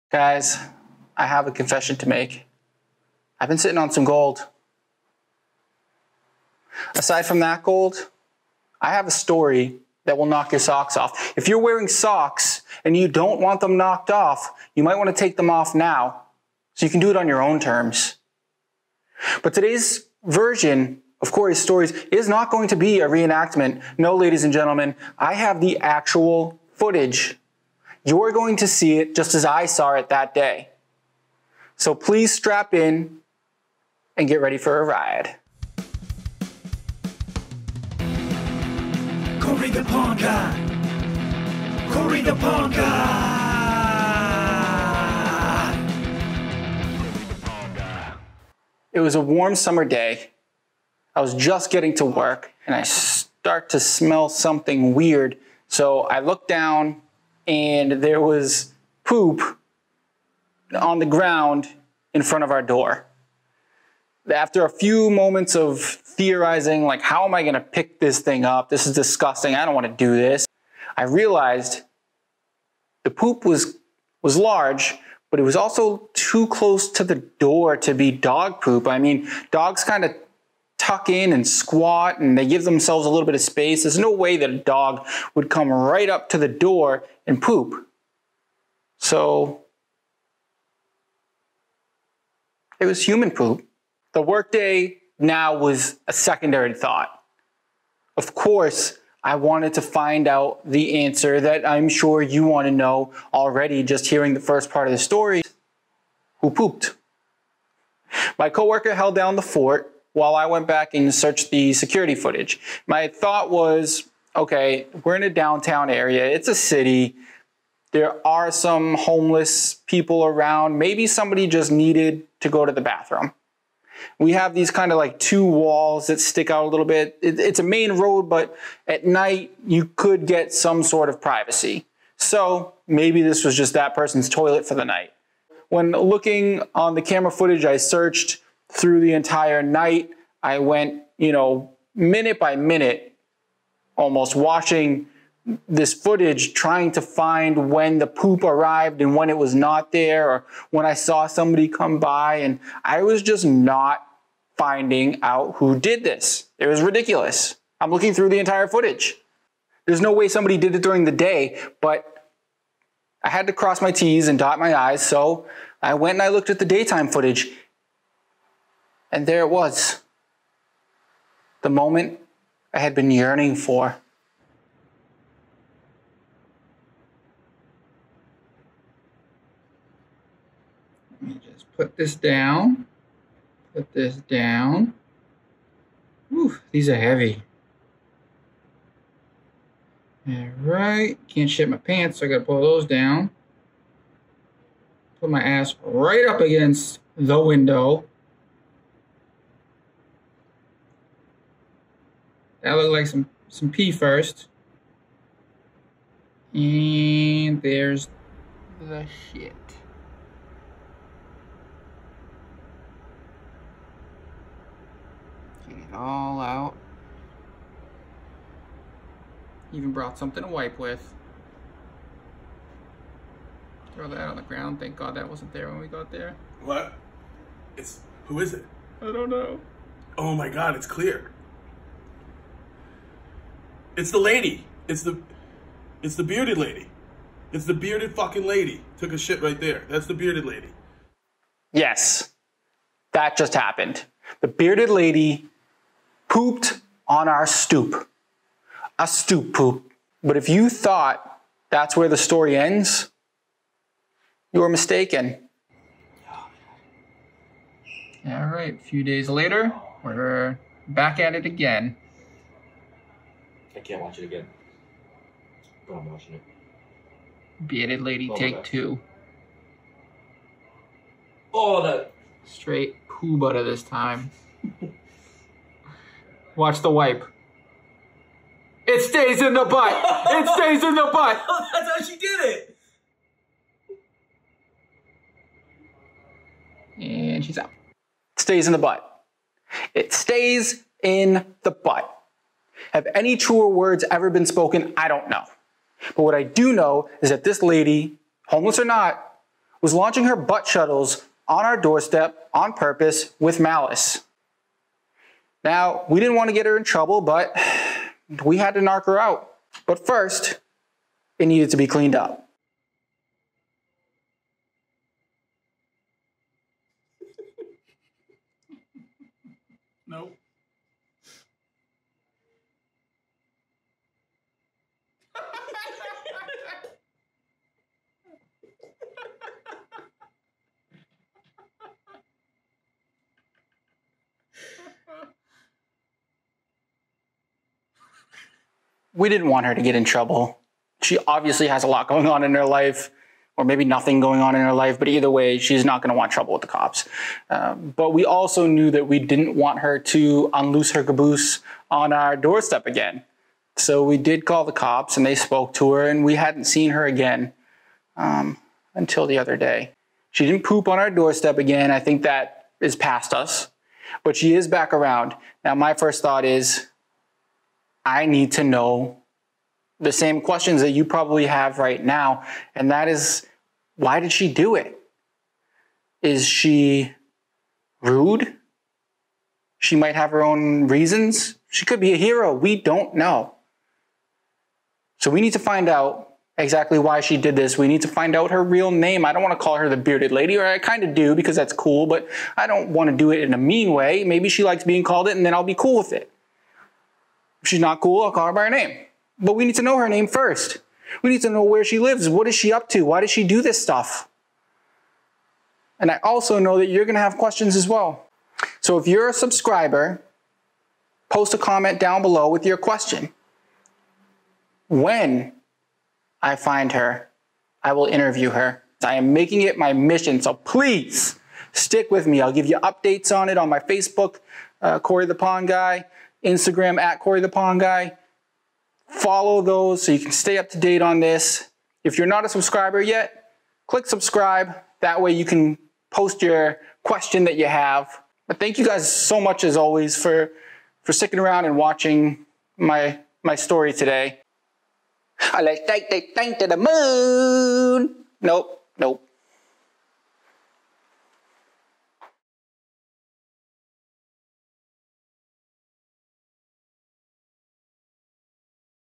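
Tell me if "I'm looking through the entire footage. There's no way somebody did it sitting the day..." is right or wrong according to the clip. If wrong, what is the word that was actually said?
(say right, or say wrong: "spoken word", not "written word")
wrong: "during", not "sitting".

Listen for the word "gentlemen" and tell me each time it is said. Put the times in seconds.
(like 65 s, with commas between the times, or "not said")
24 s.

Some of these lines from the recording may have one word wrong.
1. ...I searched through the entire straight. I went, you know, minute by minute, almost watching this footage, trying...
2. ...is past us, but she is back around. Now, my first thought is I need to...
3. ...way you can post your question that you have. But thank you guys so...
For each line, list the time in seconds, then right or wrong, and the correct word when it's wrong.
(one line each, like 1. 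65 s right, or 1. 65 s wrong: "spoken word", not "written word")
1. 137 s wrong: "night", not "straight"
2. 362 s right
3. 435 s right.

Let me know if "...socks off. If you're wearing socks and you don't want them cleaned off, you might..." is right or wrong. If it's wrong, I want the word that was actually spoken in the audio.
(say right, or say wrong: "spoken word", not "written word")
wrong: "knocked", not "cleaned".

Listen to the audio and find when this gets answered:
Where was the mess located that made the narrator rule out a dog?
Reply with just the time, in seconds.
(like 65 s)
76 s.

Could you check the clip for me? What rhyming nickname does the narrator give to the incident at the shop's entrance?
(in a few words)
A stoop poop.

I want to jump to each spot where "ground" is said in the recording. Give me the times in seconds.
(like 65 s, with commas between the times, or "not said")
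61 s, 224 s.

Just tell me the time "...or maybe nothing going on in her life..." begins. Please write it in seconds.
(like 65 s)
343 s.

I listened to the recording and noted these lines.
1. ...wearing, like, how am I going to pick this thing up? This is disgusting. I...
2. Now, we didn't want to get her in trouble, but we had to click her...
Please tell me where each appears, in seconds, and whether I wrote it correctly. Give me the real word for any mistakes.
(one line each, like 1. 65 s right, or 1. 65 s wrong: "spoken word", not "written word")
1. 65 s wrong: "theorizing", not "wearing"
2. 305 s wrong: "knock", not "click".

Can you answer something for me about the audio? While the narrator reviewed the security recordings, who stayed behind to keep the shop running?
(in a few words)
My coworker.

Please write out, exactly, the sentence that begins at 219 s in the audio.
Even brought something to wipe with.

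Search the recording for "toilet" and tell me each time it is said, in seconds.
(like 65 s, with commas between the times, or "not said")
134 s.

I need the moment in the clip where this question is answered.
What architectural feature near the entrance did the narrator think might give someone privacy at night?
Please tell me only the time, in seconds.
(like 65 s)
125 s.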